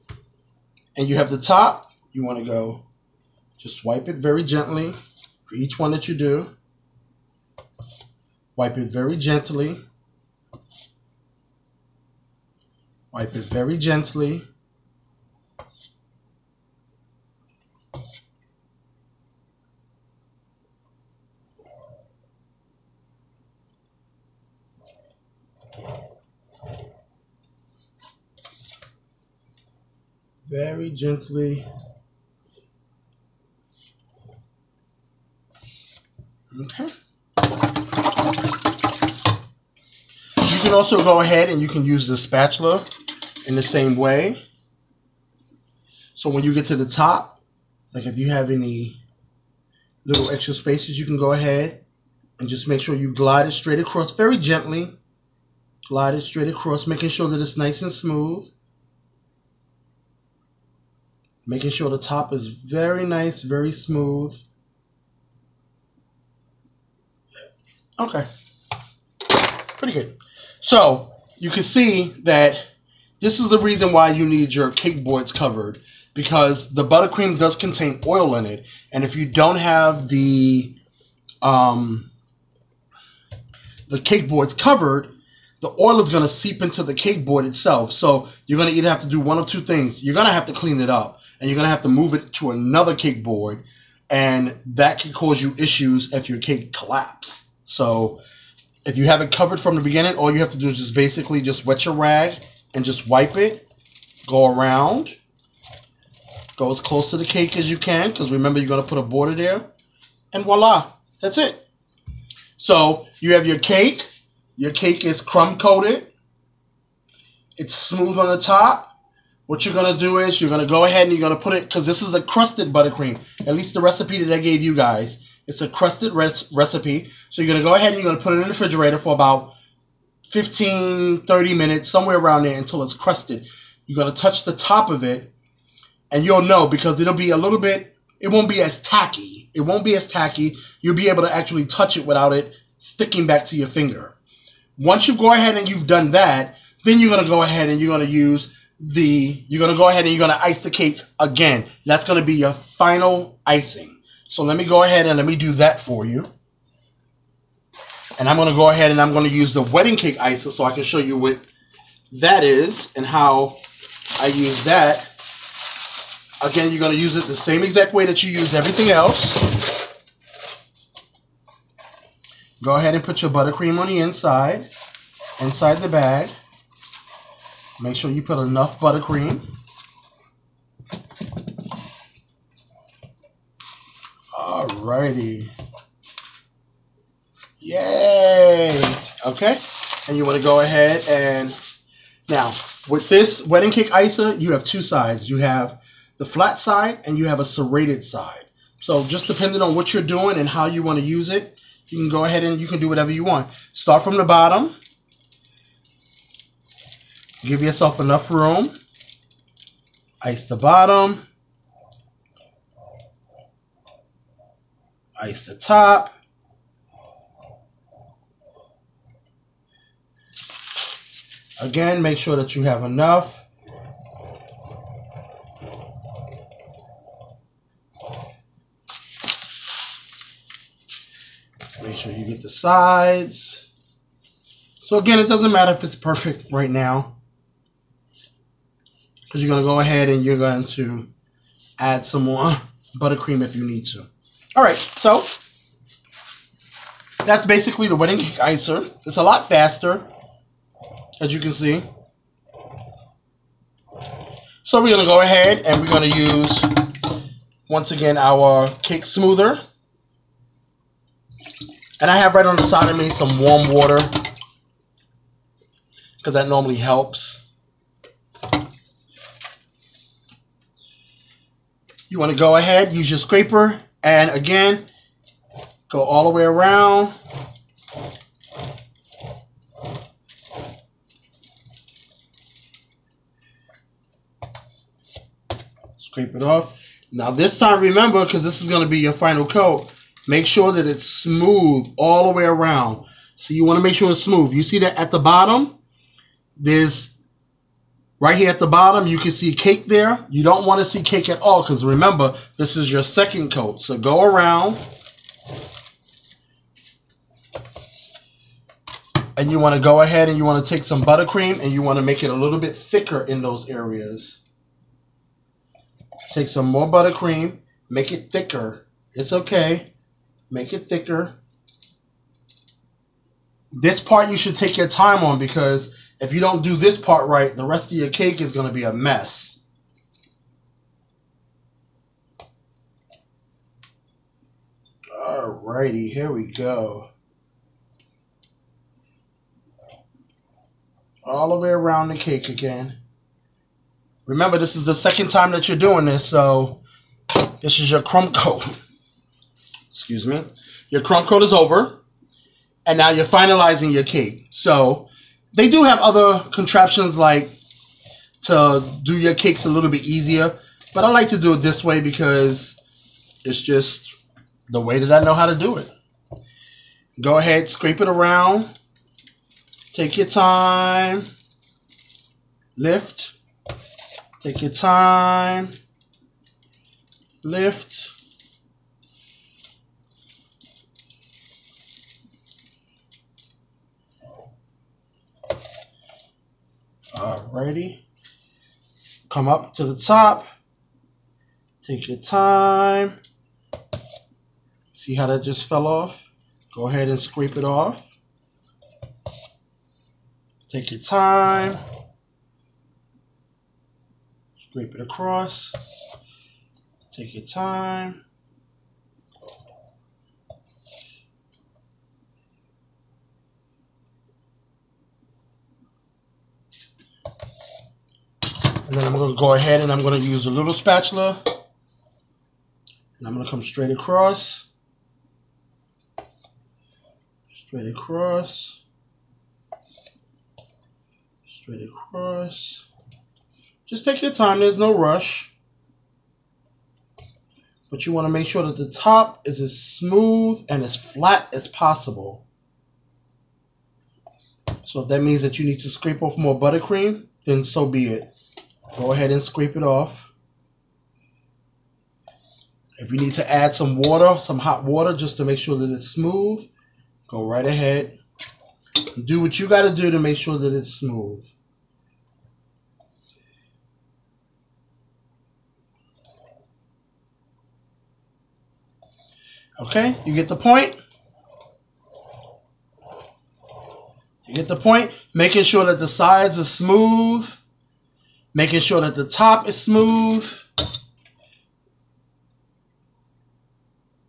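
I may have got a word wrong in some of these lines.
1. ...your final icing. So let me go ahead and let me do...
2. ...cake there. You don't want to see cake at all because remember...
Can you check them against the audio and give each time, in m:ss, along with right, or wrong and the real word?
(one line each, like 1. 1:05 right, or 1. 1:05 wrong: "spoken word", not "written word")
1. 2:32 right
2. 4:59 right.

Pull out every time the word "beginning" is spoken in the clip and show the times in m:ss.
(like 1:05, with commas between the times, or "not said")
1:39.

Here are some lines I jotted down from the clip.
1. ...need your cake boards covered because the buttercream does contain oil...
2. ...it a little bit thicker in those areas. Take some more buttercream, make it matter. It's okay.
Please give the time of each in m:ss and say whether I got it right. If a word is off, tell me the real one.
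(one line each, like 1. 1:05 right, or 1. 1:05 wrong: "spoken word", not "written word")
1. 1:14 right
2. 5:12 wrong: "thicker", not "matter".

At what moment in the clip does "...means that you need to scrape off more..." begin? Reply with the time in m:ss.
7:25.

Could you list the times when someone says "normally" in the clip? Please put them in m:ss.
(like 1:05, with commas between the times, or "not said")
4:26.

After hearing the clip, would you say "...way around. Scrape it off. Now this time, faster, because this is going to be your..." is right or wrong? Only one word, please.
wrong.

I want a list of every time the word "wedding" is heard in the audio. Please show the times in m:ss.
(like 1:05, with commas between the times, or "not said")
2:39, 3:13, 4:07.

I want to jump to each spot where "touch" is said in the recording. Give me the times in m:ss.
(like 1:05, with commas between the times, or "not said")
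2:14, 2:21.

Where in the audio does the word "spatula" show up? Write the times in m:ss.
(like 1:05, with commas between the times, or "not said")
0:42, 7:00.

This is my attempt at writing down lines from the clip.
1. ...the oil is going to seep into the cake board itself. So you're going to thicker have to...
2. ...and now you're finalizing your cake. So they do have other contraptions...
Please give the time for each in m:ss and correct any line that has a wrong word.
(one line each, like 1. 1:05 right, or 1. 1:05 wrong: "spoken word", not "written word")
1. 1:25 wrong: "either", not "thicker"
2. 5:52 right.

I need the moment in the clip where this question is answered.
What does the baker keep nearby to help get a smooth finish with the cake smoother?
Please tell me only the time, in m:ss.
4:23.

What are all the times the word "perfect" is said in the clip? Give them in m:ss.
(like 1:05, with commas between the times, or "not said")
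3:55.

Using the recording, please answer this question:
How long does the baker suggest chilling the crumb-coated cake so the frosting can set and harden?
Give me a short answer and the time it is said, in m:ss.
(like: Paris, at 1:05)
15 to 30 minutes, at 2:10.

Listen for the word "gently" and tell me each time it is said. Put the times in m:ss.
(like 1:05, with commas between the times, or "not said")
0:04, 0:09, 0:13, 0:30, 0:54.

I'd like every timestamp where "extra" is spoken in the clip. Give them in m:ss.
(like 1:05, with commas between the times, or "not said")
0:50.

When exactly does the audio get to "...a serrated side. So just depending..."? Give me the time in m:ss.
3:17.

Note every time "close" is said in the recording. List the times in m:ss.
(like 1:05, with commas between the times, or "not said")
1:46.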